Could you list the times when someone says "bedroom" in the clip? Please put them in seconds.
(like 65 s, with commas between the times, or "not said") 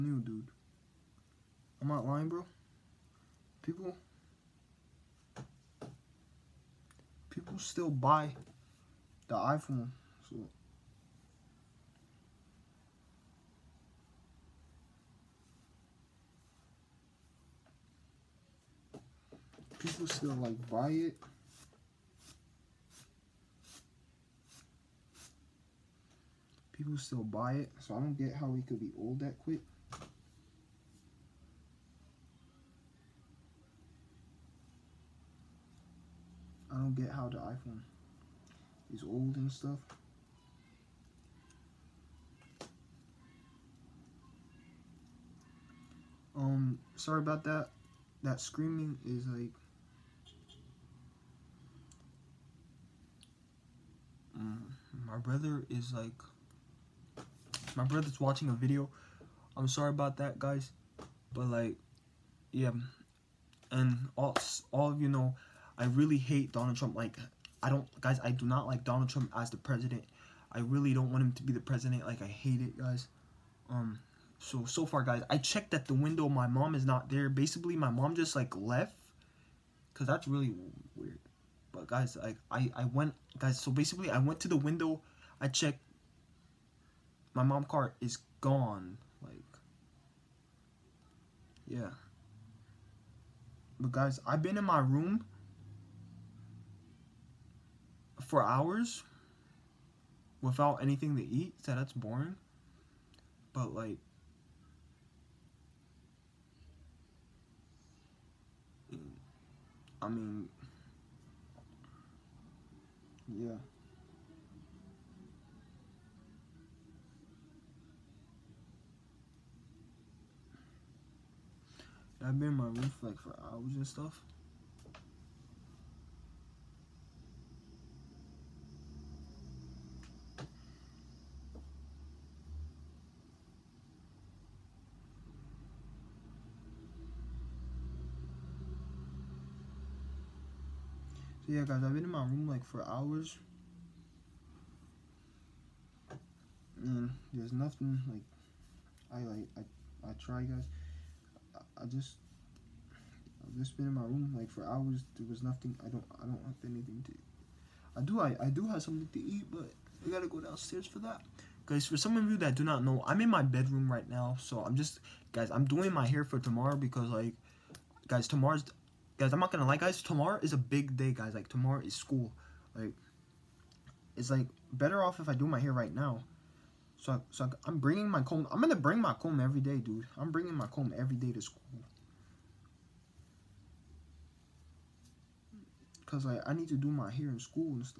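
163 s.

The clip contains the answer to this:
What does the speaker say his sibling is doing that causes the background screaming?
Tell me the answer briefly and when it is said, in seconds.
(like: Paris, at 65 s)
watching a video, at 58 s.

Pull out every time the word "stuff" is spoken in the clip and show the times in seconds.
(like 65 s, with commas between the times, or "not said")
39 s, 123 s.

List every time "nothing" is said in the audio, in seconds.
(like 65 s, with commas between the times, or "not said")
147 s, 155 s.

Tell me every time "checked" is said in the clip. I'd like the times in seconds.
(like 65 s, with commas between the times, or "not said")
75 s, 85 s.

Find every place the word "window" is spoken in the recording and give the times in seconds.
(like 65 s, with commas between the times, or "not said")
75 s, 84 s.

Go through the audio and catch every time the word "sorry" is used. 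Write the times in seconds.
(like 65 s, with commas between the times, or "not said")
46 s, 59 s.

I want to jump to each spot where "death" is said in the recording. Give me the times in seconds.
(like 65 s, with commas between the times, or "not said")
not said.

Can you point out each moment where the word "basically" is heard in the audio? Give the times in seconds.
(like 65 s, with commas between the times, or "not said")
77 s, 83 s.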